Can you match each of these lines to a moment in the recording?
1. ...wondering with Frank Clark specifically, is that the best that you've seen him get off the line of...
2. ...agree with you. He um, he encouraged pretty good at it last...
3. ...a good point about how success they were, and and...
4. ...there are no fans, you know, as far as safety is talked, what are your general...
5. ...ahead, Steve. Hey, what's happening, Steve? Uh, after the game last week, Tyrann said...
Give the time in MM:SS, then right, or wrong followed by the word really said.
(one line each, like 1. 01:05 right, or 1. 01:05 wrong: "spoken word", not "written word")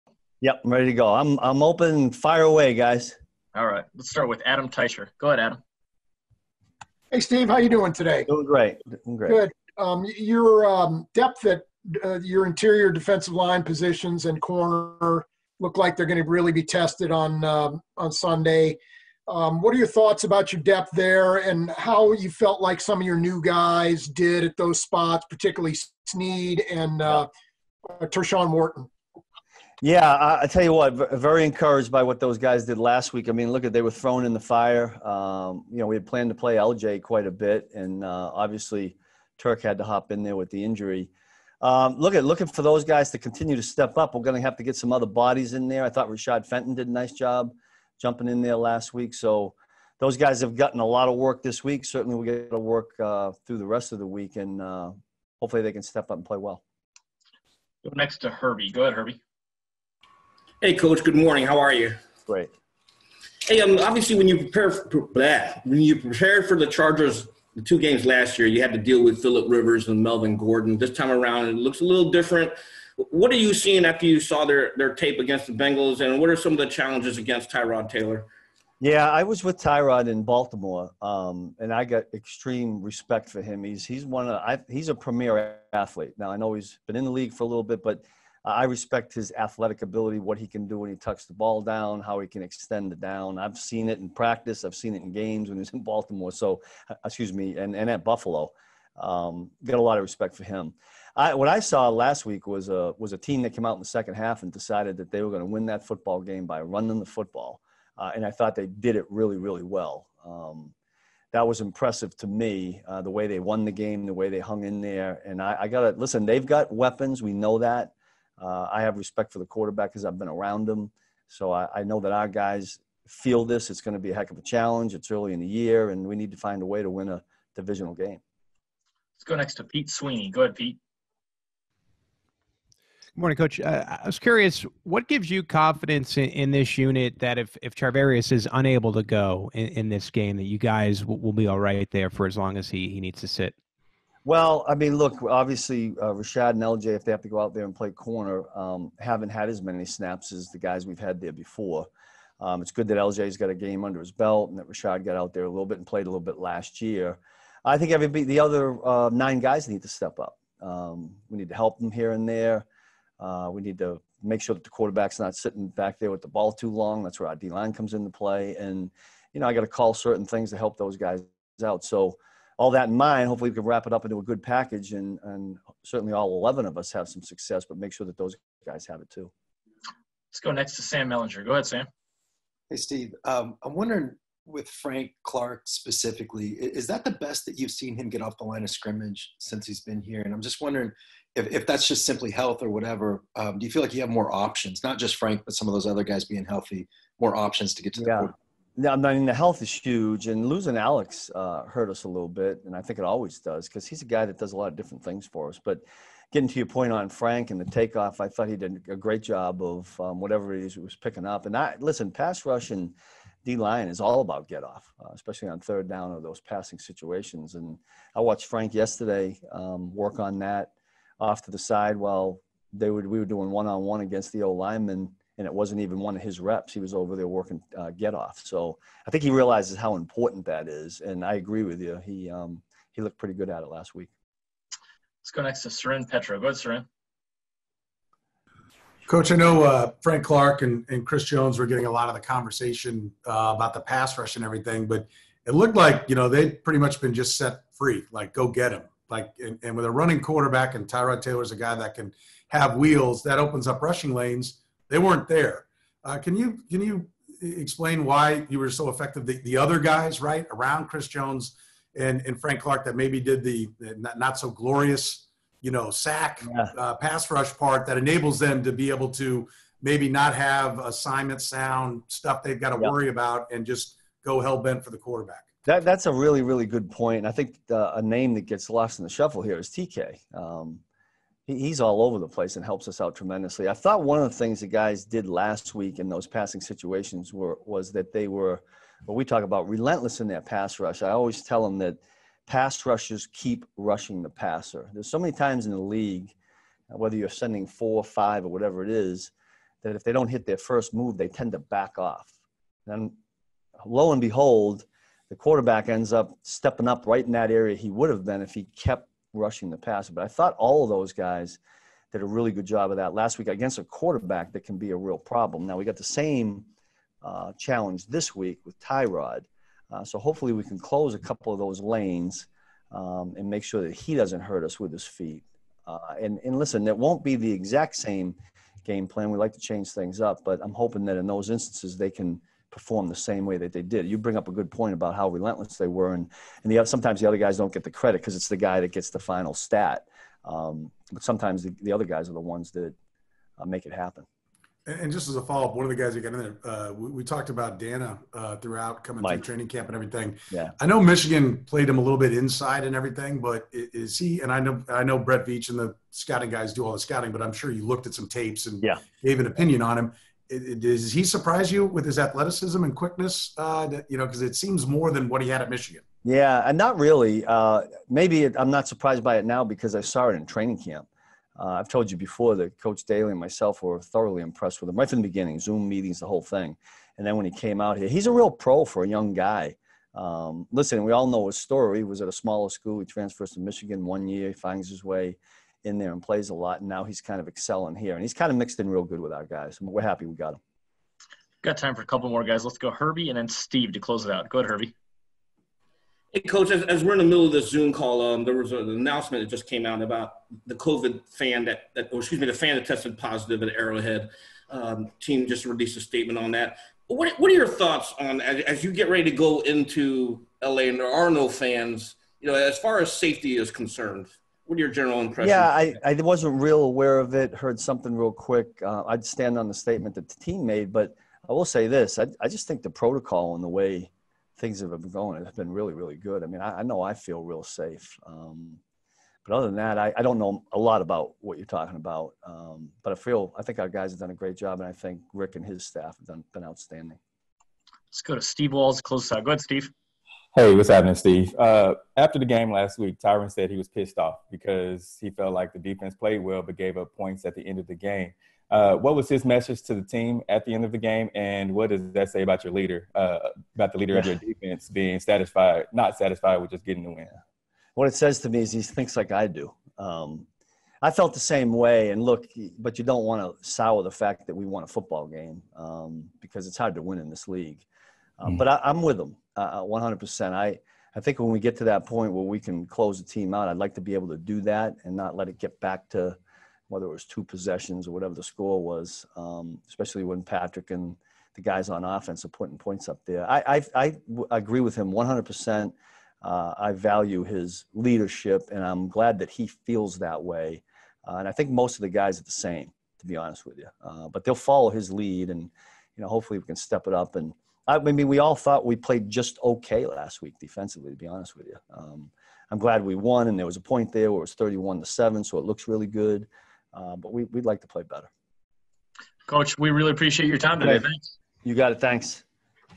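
1. 03:03 right
2. 03:51 wrong: "looked", not "encouraged"
3. 05:34 wrong: "relentless", not "success"
4. 06:50 wrong: "concerned", not "talked"
5. 07:19 right.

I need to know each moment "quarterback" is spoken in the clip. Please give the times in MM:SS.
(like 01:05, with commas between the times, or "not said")
01:59, 02:44, 04:10, 04:34, 05:05, 05:13.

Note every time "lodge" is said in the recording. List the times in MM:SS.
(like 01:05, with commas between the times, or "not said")
not said.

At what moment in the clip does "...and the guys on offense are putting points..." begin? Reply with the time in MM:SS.
08:00.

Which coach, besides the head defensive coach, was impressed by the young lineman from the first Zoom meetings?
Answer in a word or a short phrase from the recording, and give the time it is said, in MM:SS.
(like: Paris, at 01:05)
Coach Daly, at 06:12.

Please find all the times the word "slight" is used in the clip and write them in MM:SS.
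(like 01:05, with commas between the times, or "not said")
not said.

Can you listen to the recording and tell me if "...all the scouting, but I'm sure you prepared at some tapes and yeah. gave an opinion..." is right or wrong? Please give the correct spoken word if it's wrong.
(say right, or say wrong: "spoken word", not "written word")
wrong: "looked", not "prepared".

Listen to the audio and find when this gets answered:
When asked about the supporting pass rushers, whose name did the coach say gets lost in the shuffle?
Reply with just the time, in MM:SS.
04:39.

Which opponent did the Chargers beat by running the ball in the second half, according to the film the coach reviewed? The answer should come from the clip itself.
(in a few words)
Bengals.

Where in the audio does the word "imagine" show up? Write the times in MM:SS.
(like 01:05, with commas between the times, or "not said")
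not said.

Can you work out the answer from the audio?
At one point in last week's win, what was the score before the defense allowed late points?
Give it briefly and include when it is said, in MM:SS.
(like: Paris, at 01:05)
31 to 7, at 08:24.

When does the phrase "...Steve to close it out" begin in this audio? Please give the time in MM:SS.
06:33.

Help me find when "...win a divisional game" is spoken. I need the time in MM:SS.
02:06.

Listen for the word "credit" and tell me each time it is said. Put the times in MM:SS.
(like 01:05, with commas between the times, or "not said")
05:37.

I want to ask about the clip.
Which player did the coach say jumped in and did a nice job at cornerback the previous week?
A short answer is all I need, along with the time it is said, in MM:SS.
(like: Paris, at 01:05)
Rashad Fenton, at 00:46.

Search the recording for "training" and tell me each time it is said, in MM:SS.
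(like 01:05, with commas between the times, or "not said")
05:49, 06:10.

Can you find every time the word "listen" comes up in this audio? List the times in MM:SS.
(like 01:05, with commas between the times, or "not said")
01:55, 03:31, 05:26, 06:20.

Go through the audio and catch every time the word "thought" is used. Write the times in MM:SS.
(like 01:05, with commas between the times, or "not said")
00:19, 00:45, 01:48, 03:28, 04:43, 05:10, 06:47, 08:18.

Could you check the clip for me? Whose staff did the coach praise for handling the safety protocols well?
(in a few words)
Rick.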